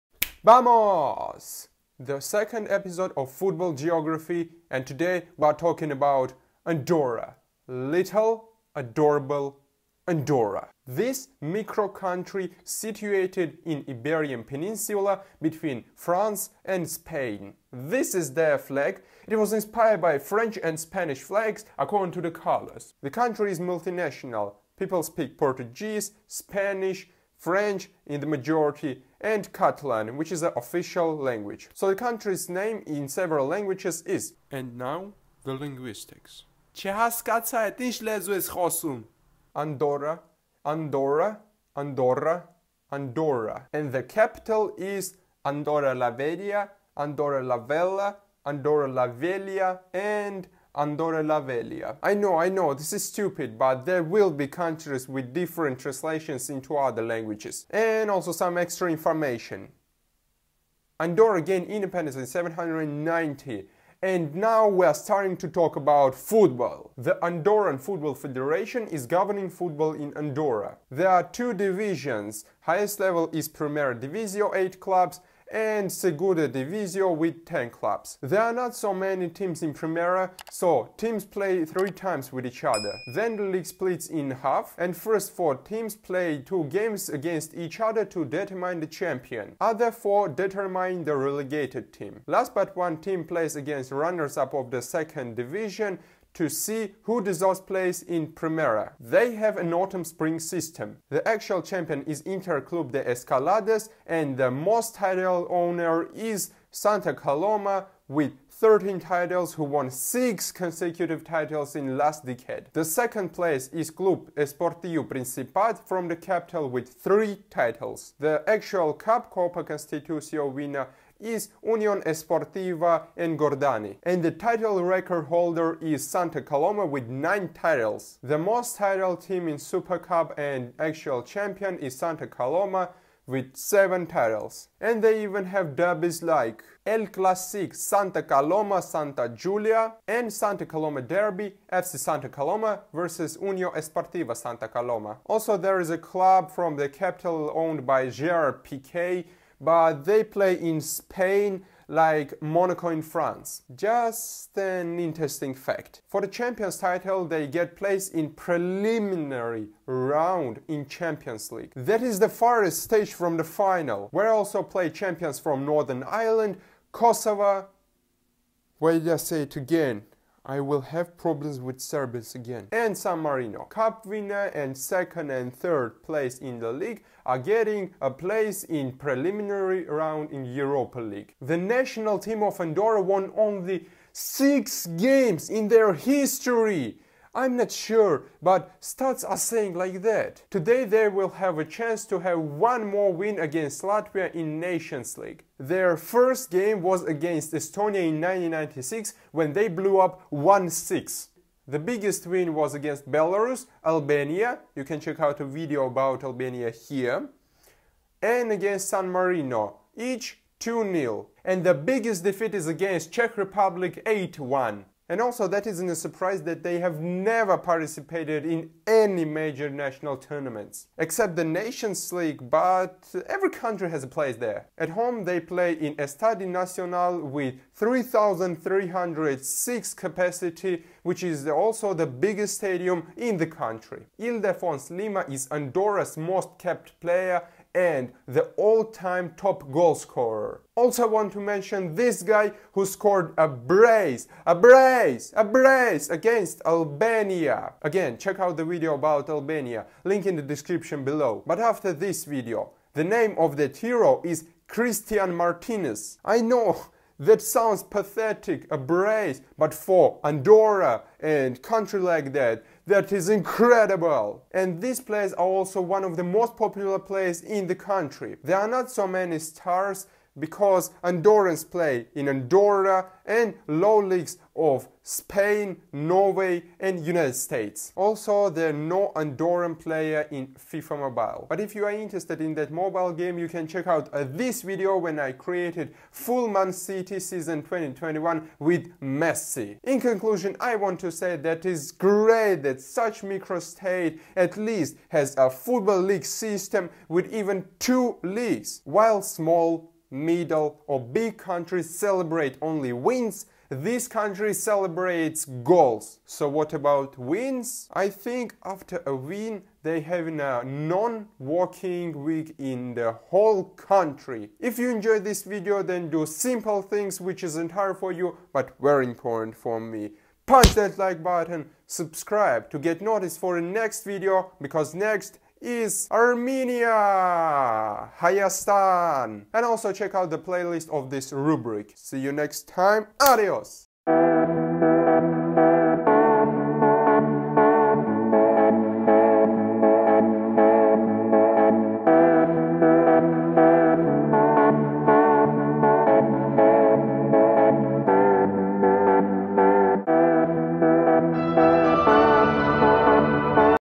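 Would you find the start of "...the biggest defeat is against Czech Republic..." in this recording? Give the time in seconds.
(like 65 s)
211 s.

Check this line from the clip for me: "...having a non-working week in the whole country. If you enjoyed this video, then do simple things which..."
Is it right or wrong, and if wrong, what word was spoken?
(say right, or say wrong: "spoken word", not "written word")
right.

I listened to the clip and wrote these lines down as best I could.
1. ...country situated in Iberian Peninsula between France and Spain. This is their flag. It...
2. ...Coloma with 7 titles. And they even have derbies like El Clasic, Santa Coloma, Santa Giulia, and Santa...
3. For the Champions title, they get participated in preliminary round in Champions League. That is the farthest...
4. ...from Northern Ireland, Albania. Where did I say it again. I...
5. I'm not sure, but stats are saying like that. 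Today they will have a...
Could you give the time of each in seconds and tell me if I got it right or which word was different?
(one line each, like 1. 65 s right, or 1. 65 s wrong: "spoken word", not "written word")
1. 11 s right
2. 132 s right
3. 156 s wrong: "placed", not "participated"
4. 165 s wrong: "Kosovo", not "Albania"
5. 187 s right.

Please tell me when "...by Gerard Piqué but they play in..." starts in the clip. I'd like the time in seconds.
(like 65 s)
147 s.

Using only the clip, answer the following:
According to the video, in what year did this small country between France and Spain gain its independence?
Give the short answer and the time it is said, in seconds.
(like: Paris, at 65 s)
790, at 62 s.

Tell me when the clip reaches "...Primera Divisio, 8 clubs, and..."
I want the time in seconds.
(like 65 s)
73 s.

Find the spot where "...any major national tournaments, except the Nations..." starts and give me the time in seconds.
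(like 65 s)
218 s.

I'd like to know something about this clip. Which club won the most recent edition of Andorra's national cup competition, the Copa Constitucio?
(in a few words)
Union Esportiva Engordany.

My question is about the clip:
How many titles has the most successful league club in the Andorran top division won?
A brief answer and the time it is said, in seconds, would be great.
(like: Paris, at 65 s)
13, at 108 s.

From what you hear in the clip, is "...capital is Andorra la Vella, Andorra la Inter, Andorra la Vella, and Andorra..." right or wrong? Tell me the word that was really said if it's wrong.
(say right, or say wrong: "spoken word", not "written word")
wrong: "Vella", not "Inter".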